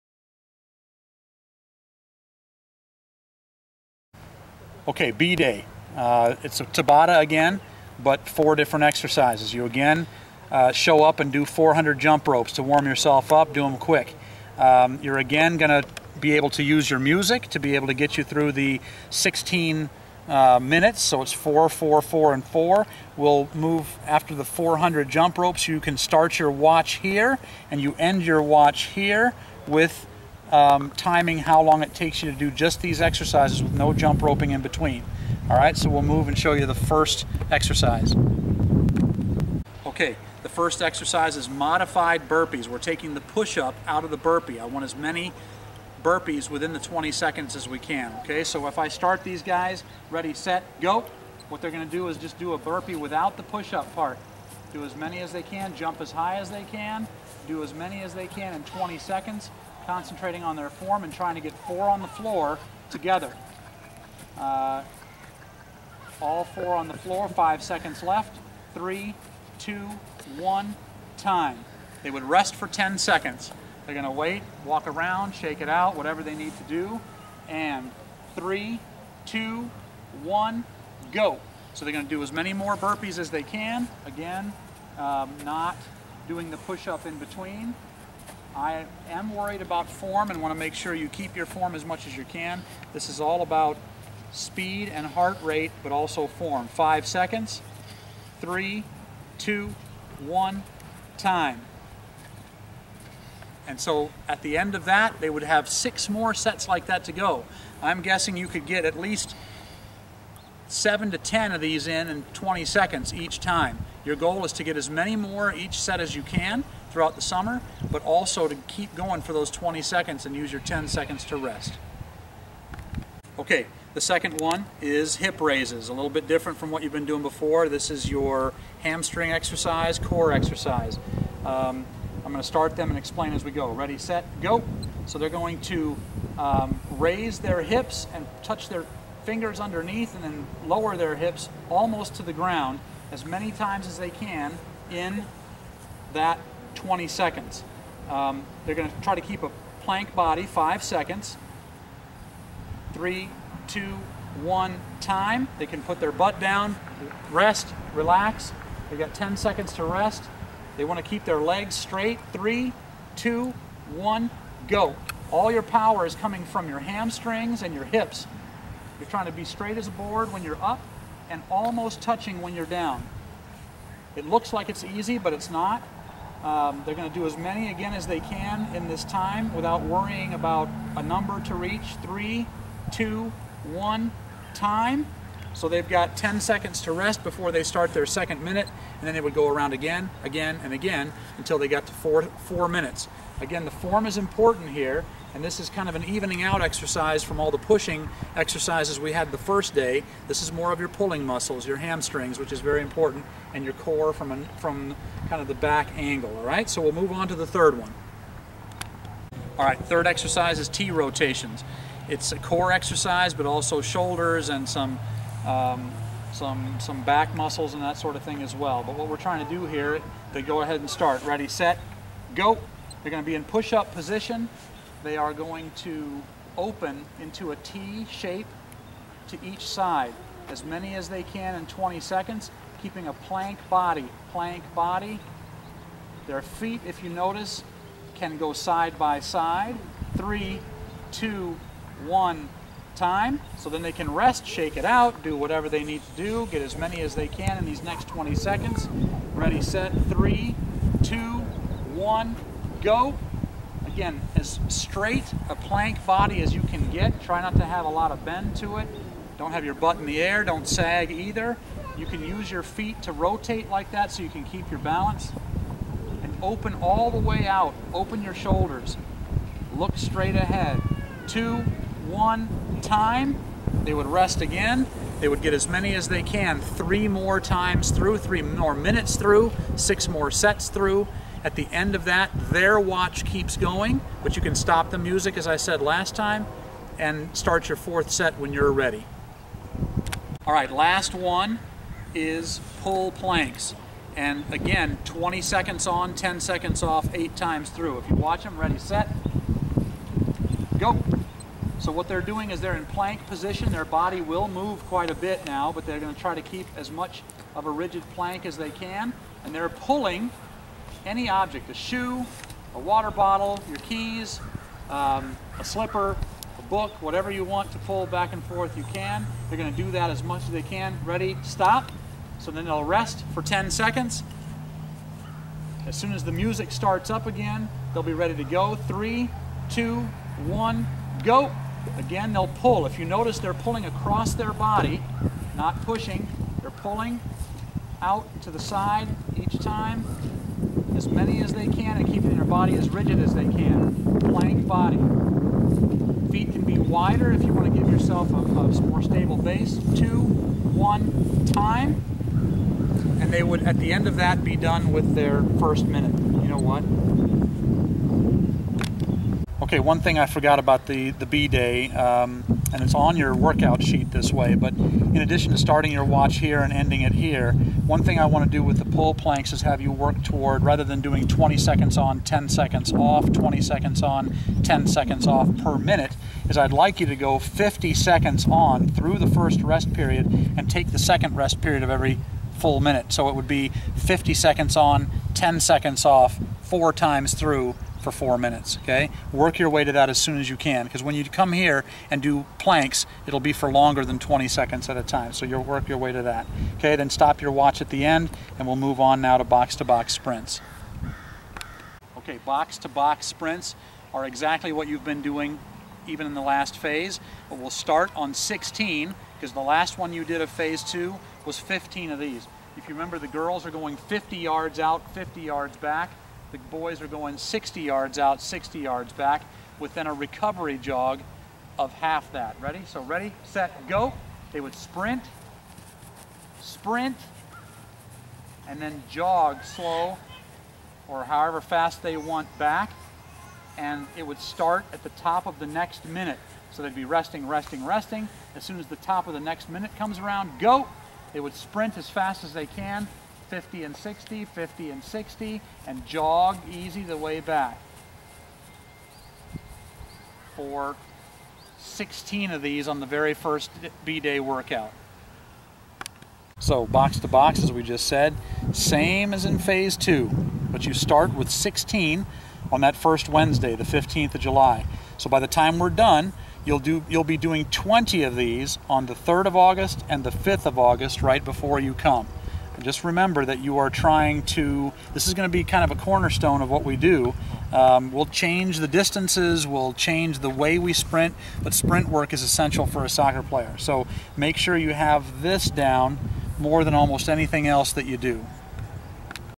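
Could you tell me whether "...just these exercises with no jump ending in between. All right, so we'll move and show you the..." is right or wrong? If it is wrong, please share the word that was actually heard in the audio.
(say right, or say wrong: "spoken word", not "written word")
wrong: "roping", not "ending".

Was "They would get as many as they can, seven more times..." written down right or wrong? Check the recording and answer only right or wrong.
wrong.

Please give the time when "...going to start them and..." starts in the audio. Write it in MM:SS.
02:12.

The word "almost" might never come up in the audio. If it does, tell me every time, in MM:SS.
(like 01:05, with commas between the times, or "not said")
02:21, 02:51, 08:06.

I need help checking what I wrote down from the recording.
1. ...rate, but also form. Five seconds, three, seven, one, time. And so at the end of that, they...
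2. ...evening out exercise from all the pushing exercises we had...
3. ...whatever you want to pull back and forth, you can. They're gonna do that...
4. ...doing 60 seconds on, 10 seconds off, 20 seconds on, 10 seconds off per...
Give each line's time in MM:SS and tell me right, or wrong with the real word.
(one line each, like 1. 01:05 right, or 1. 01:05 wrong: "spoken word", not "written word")
1. 01:35 wrong: "two", not "seven"
2. 03:16 right
3. 05:17 right
4. 06:11 wrong: "20", not "60".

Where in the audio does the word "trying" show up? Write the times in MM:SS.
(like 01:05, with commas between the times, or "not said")
01:01, 02:49, 03:39, 07:53.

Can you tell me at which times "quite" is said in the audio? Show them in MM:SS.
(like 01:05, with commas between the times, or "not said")
05:04.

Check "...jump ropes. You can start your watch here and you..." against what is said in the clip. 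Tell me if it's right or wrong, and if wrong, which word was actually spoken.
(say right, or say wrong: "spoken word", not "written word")
right.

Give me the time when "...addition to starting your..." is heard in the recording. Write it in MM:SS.
06:05.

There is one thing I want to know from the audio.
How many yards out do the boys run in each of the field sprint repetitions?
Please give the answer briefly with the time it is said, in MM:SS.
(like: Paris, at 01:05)
60 yards, at 06:57.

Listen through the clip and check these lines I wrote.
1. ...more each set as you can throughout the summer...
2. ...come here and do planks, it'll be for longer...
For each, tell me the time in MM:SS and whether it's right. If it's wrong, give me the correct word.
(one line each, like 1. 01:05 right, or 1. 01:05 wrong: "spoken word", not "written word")
1. 01:55 right
2. 06:31 right.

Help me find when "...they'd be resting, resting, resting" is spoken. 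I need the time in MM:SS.
07:16.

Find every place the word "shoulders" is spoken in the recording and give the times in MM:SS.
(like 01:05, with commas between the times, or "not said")
03:33, 04:28.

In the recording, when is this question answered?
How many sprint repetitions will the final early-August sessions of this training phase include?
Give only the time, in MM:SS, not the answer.
07:47.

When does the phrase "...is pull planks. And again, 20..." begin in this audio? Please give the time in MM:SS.
04:52.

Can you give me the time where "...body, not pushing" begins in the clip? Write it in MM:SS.
05:34.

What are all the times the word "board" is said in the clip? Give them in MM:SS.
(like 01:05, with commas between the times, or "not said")
02:49.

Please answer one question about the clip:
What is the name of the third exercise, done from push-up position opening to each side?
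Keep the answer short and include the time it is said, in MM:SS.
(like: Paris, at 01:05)
T rotations, at 03:30.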